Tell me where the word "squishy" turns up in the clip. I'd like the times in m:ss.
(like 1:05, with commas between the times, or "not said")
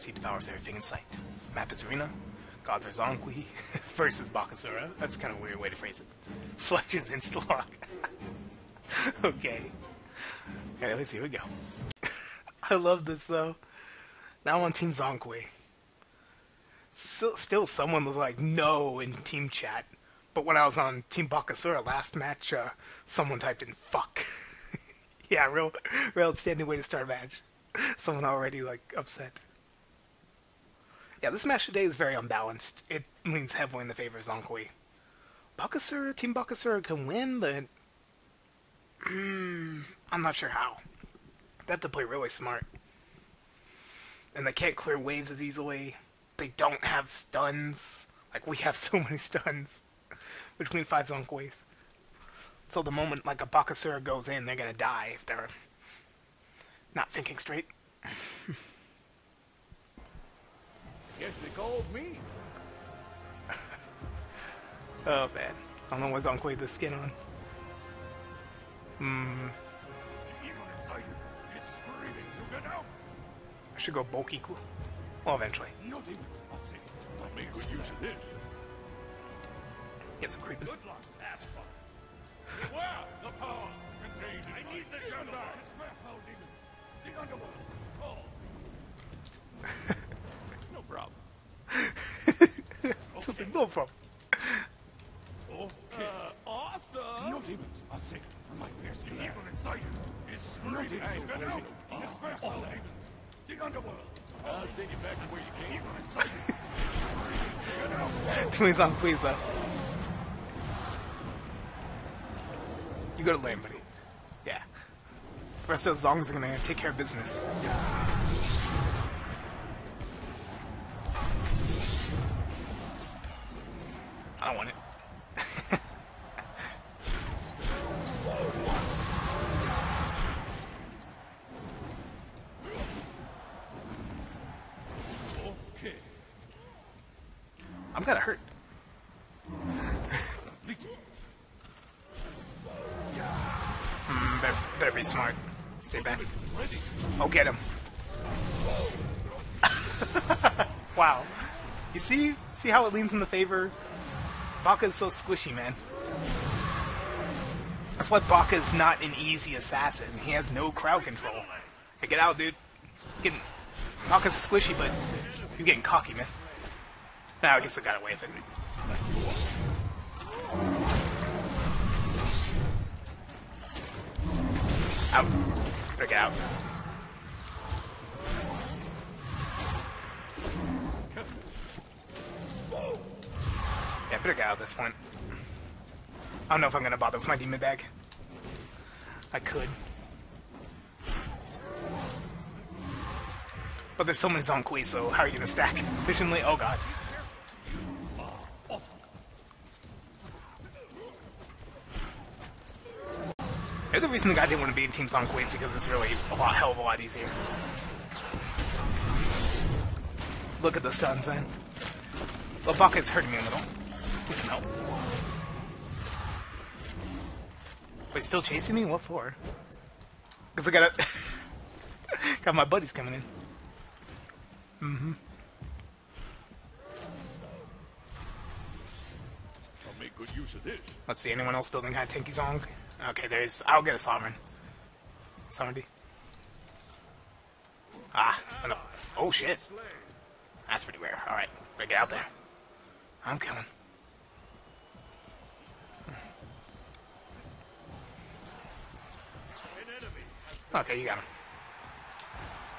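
2:35, 2:44.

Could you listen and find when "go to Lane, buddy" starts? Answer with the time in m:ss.
1:53.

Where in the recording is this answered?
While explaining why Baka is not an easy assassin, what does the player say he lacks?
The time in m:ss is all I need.
2:40.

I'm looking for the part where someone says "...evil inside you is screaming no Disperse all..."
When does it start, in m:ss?
1:39.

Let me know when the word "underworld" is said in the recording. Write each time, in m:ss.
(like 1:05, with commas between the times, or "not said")
1:27, 1:43.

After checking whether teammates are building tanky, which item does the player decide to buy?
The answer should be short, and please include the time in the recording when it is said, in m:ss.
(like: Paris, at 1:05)
Sovereignty, at 3:55.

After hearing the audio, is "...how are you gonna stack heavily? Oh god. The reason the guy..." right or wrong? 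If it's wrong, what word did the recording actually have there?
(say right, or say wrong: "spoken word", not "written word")
wrong: "efficiently", not "heavily".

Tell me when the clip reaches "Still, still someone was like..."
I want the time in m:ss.
0:16.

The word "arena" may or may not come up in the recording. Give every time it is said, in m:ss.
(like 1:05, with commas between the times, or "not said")
0:01.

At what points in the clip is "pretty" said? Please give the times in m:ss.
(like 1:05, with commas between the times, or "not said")
2:24, 4:00.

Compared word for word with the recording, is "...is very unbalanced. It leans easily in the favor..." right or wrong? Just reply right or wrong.
wrong.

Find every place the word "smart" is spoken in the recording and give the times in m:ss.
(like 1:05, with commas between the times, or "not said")
0:42, 2:25.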